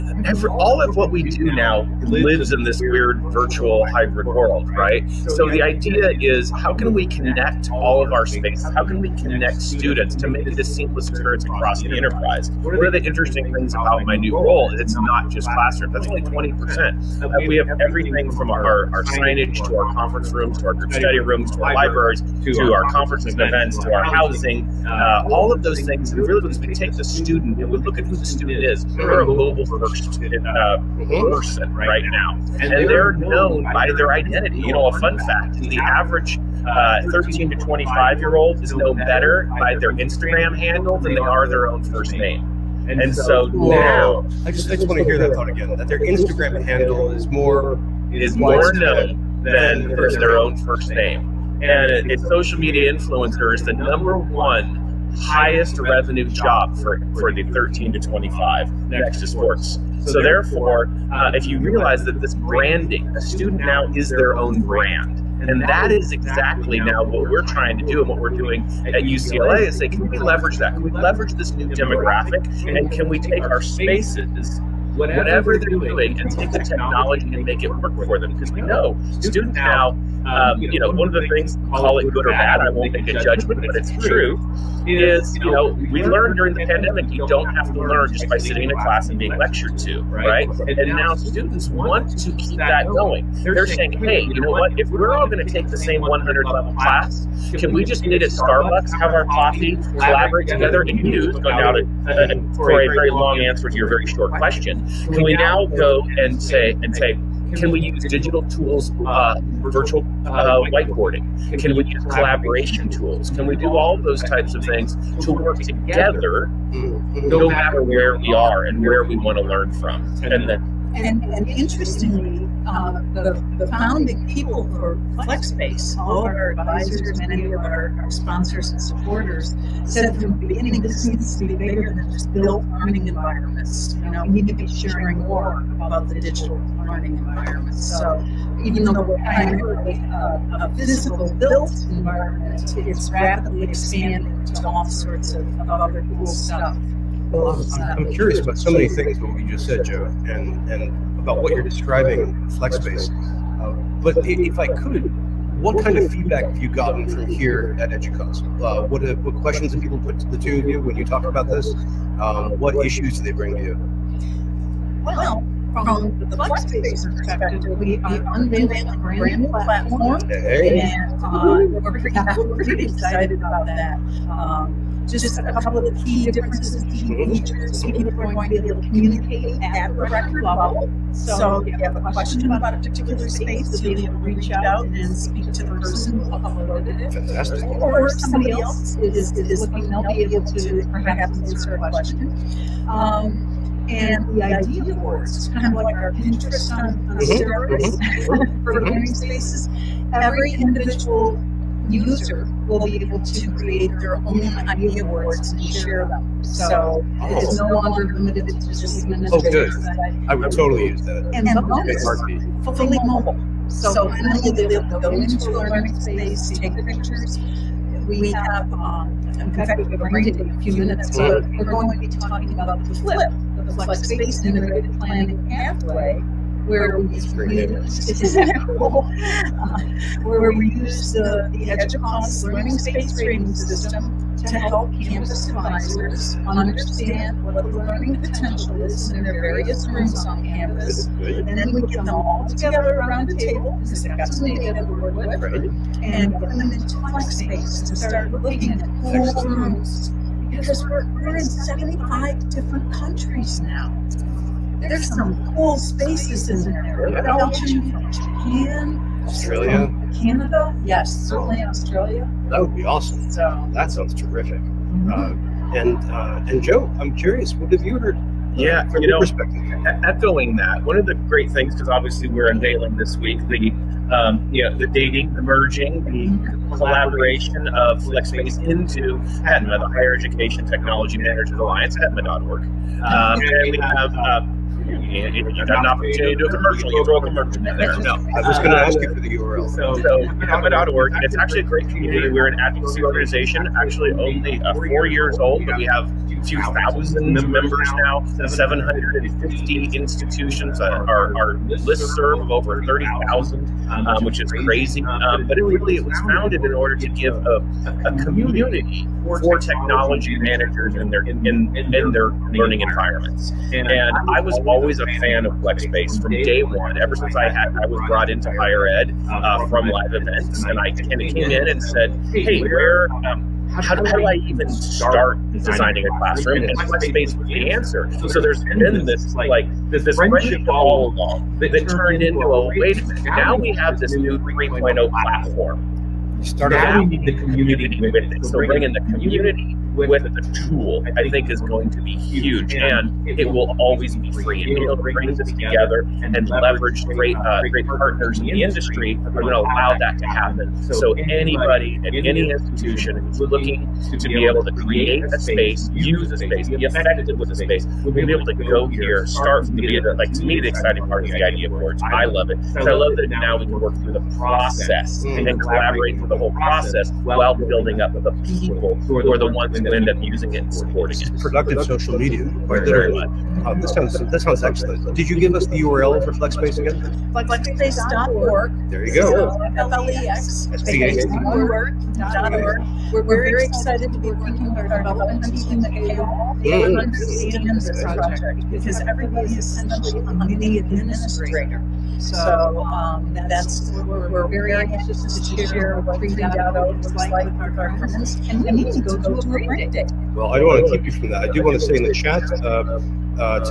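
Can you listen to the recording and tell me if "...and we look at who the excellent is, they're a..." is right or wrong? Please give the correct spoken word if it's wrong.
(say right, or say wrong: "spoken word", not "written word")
wrong: "student", not "excellent".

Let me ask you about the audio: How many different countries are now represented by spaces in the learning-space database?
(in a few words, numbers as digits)
75.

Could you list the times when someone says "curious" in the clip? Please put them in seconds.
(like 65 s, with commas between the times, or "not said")
148 s, 267 s.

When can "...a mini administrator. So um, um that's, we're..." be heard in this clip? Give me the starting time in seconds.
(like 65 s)
390 s.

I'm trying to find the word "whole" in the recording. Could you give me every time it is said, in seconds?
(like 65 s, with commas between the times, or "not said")
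248 s, 366 s.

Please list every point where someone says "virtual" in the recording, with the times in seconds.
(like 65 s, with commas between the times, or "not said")
3 s, 109 s.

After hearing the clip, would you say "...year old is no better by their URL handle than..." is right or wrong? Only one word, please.
wrong.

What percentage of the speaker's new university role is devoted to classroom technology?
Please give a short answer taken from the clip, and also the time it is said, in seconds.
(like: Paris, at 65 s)
20%, at 16 s.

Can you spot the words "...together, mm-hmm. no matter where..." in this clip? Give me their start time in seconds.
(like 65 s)
115 s.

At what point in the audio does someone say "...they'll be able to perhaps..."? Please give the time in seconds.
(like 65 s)
189 s.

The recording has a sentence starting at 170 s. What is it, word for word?
and uh, we're pretty, pretty, excited about that.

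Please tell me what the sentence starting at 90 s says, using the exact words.
And now students want to keep that going.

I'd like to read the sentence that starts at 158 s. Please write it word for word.
Uh, what, have, uh, what questions have people put to the two of you when you talk about this?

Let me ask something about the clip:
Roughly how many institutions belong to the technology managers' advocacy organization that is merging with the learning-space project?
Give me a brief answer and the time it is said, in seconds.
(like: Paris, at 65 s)
750, at 298 s.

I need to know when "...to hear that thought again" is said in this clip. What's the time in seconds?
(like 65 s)
44 s.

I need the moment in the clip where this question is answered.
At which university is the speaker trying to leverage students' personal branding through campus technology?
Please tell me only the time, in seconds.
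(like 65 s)
69 s.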